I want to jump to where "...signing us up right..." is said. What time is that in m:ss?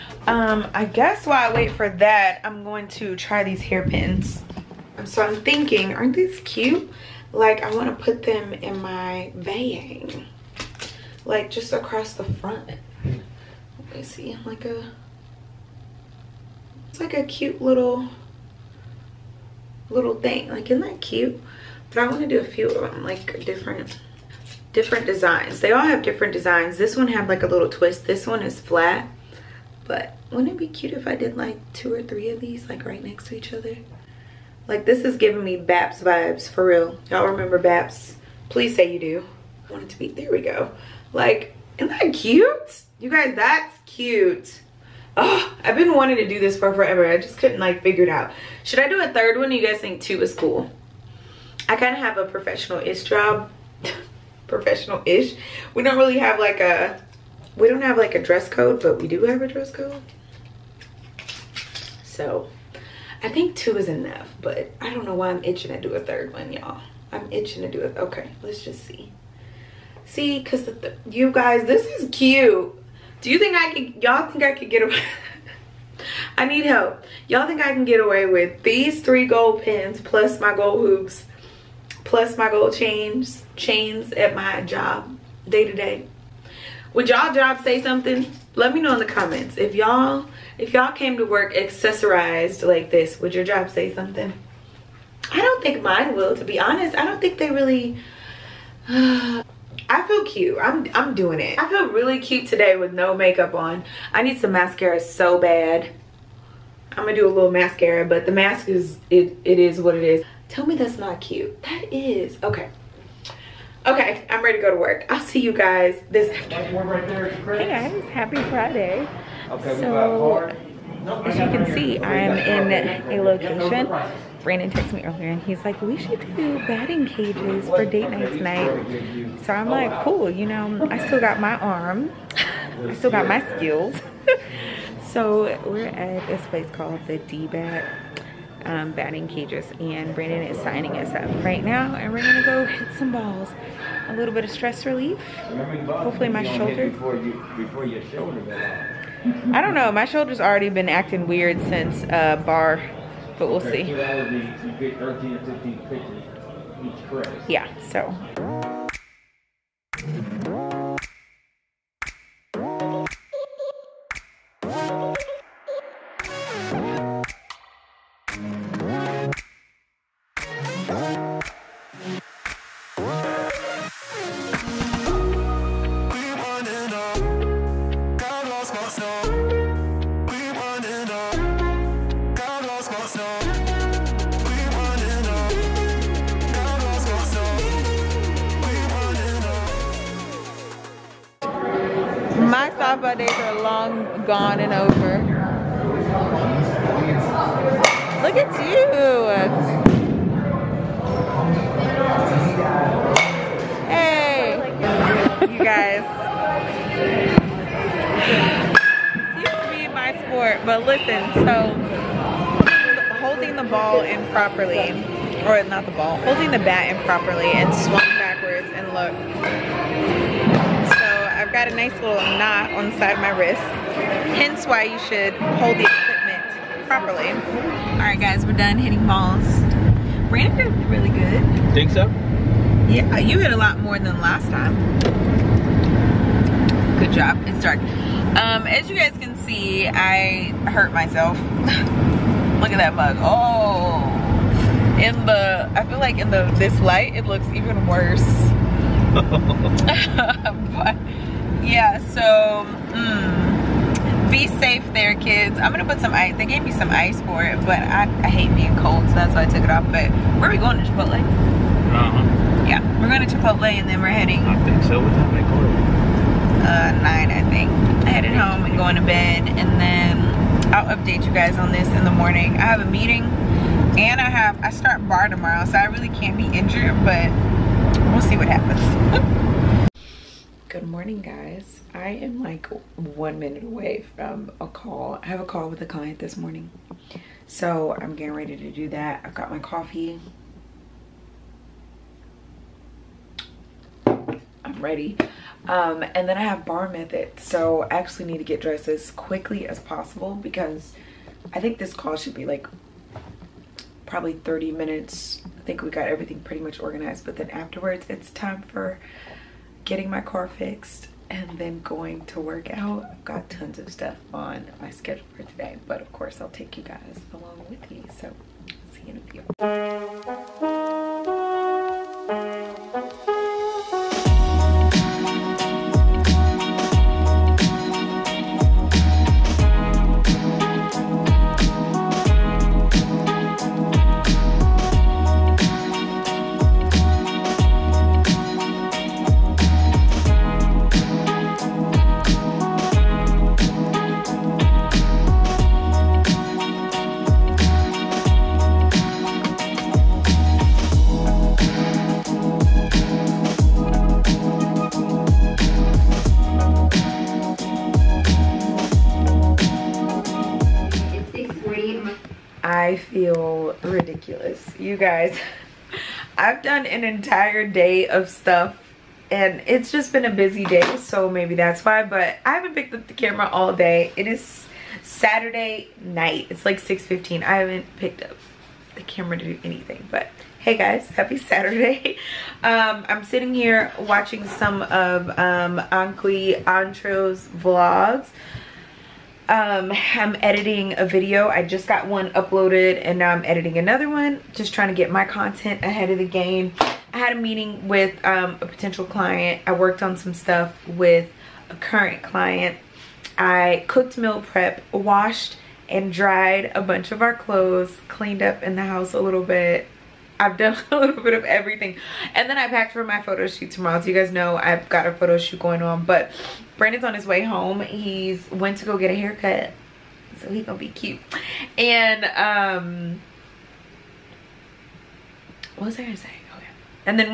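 2:20.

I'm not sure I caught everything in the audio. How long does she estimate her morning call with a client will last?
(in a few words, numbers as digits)
30 minutes.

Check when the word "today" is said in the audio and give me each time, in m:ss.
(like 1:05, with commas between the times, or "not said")
1:42, 5:15.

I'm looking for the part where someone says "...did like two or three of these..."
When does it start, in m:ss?
0:31.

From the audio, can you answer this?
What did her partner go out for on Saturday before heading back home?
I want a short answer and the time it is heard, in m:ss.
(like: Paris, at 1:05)
a haircut, at 6:59.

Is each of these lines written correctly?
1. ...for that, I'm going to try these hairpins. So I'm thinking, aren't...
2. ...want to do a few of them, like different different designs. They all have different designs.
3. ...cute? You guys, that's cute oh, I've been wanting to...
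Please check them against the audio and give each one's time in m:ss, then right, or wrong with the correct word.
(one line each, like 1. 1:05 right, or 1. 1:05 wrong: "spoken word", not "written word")
1. 0:01 right
2. 0:22 right
3. 0:42 right.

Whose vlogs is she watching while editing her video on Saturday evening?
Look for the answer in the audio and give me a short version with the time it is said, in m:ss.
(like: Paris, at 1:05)
Antro, at 6:25.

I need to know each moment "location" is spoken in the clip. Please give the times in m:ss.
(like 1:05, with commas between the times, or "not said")
2:03.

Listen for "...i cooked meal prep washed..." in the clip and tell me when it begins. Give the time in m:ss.
6:43.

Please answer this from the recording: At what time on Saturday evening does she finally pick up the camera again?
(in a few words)
6:15.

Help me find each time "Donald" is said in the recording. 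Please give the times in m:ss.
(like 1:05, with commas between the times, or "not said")
not said.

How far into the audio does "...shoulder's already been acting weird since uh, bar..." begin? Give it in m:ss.
2:30.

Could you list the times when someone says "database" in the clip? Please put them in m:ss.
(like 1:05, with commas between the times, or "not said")
not said.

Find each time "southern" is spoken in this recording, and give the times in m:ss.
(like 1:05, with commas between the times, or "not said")
not said.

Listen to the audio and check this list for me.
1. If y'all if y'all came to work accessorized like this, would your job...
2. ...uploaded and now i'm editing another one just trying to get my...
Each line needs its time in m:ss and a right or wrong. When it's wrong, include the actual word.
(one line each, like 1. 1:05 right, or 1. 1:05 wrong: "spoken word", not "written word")
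1. 1:29 right
2. 6:32 right.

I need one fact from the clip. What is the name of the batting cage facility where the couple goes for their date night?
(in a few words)
D-Bat.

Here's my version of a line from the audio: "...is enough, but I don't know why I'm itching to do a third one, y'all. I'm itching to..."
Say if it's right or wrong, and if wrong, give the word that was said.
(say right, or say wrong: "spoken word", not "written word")
right.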